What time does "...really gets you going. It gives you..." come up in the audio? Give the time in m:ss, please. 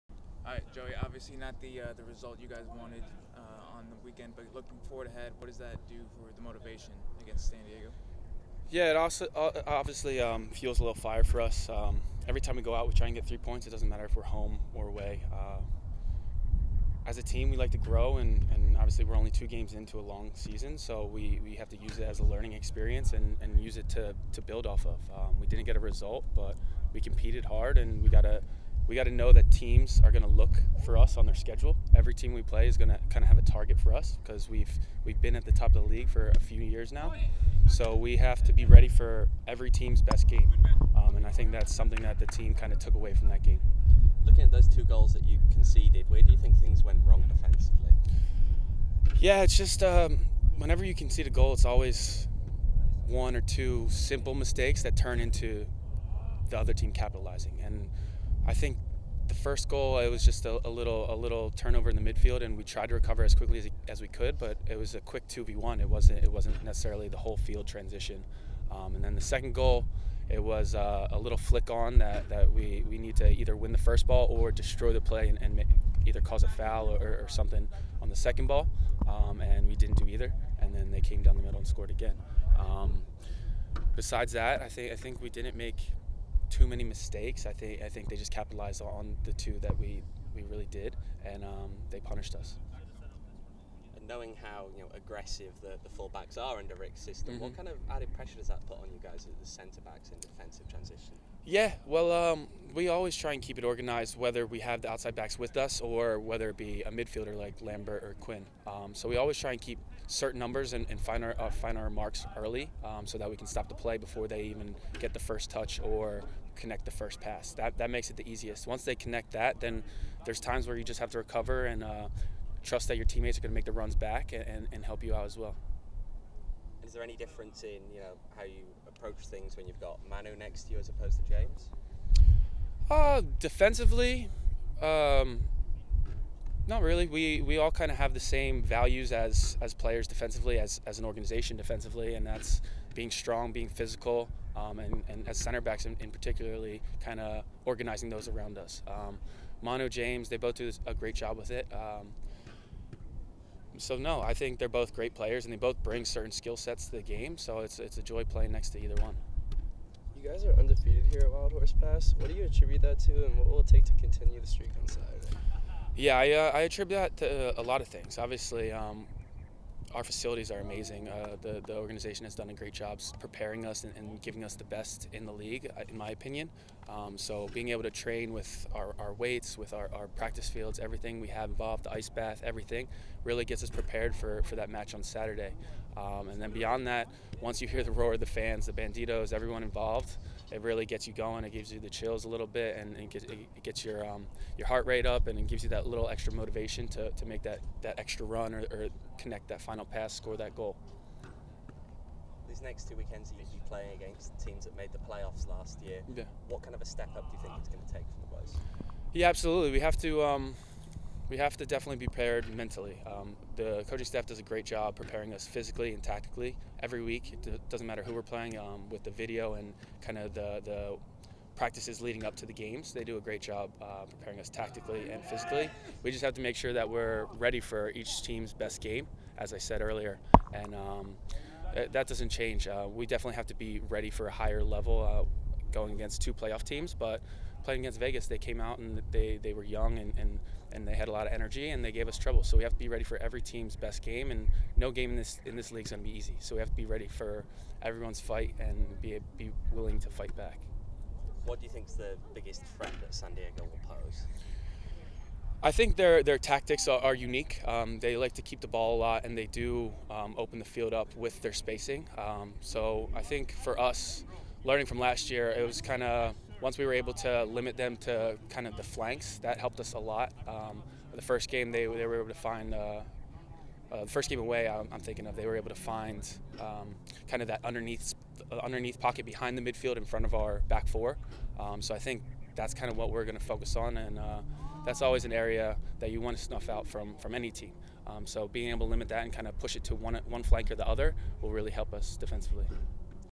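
3:10.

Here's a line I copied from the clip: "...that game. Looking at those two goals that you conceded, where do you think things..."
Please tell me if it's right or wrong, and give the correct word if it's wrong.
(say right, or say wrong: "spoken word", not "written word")
right.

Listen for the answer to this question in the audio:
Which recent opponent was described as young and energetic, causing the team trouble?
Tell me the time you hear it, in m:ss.
3:57.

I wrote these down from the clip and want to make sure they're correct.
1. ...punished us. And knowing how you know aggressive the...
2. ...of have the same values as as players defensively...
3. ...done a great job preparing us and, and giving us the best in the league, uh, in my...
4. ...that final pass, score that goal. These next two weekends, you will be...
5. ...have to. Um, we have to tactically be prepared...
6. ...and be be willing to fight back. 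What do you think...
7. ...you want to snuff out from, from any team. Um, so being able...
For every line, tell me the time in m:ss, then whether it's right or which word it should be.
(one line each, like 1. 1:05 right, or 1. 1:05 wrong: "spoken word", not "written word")
1. 1:32 right
2. 2:17 right
3. 2:52 right
4. 3:19 right
5. 3:29 wrong: "definitely", not "tactically"
6. 4:08 right
7. 4:46 right.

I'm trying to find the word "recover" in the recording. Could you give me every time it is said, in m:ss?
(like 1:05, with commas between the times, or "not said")
1:02, 2:01.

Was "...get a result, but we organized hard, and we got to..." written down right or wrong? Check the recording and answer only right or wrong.
wrong.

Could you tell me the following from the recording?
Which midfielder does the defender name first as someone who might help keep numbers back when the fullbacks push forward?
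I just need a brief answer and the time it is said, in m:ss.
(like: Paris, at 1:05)
Lambert, at 1:47.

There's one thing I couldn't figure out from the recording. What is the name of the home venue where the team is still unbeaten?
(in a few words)
Wild Horse Pass.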